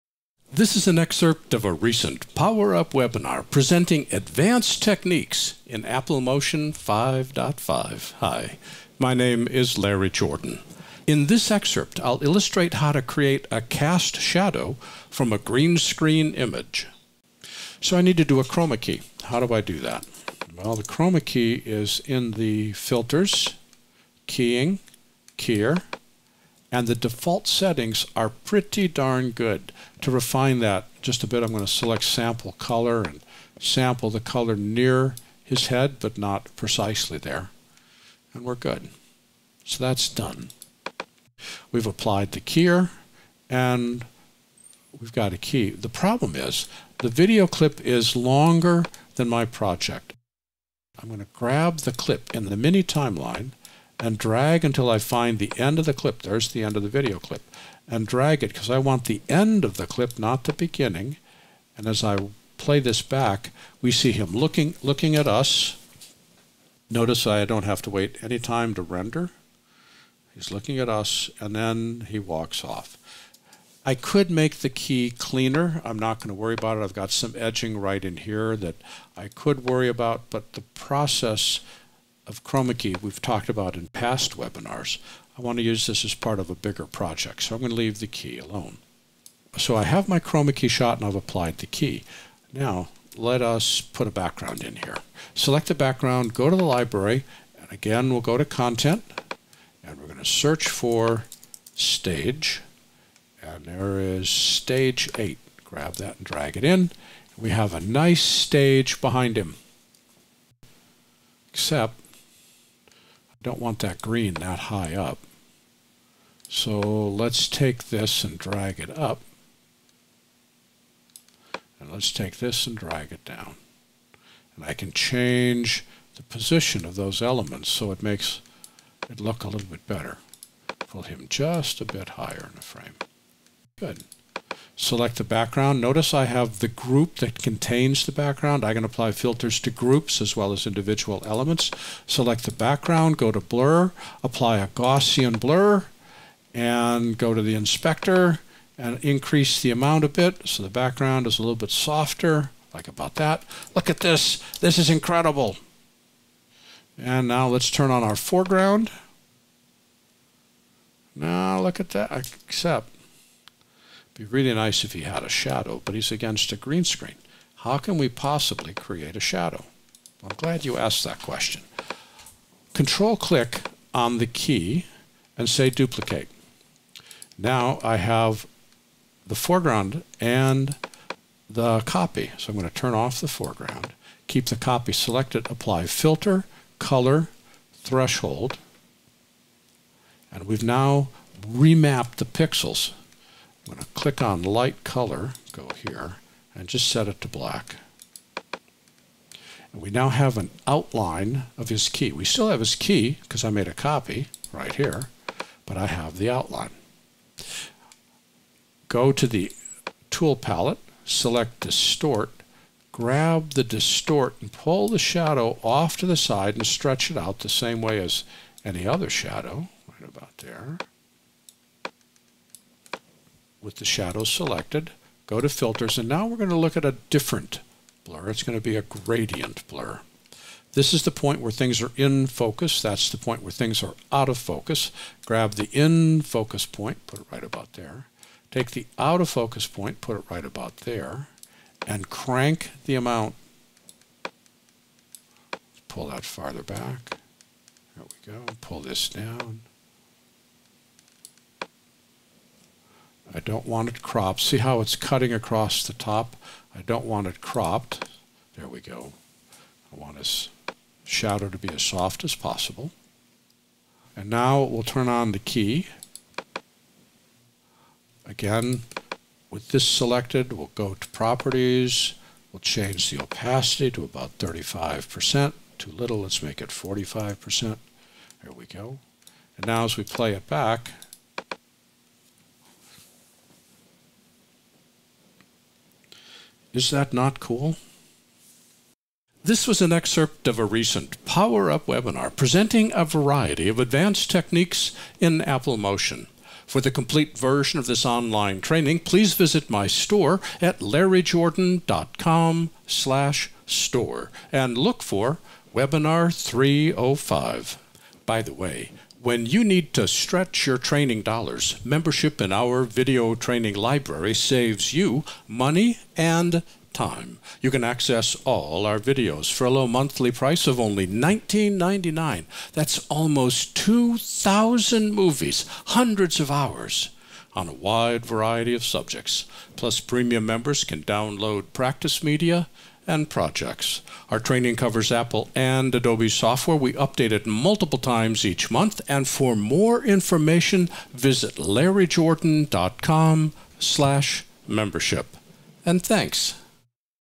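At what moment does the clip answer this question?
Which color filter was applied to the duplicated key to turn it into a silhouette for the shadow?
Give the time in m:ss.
3:07.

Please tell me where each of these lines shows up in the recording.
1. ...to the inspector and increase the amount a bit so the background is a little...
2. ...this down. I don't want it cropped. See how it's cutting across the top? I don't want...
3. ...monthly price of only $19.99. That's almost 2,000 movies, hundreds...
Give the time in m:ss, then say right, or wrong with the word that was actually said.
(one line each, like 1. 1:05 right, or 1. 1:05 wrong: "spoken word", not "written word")
1. 2:27 right
2. 4:08 right
3. 5:19 right.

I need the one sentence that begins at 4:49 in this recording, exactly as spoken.
This was an excerpt of a recent Power Up webinar presenting a variety of advanced techniques in Apple Motion.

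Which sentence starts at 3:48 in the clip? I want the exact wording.
It's going to be a gradient blur.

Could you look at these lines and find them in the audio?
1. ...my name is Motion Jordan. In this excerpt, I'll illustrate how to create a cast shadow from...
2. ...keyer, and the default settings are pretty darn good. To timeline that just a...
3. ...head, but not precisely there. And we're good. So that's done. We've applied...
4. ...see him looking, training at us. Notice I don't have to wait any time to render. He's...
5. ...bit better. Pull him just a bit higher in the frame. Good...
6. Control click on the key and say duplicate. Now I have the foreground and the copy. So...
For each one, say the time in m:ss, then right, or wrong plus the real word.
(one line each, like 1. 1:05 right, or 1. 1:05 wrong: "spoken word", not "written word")
1. 0:08 wrong: "Larry", not "Motion"
2. 0:25 wrong: "refine", not "timeline"
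3. 0:35 right
4. 1:03 wrong: "looking", not "training"
5. 2:09 right
6. 2:52 right.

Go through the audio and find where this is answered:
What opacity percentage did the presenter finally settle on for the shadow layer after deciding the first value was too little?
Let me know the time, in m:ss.
4:36.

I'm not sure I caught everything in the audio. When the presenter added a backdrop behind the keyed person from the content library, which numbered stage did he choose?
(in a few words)
Stage 8.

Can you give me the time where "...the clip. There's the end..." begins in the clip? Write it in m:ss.
0:55.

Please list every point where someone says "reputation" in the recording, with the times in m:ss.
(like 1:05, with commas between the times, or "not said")
not said.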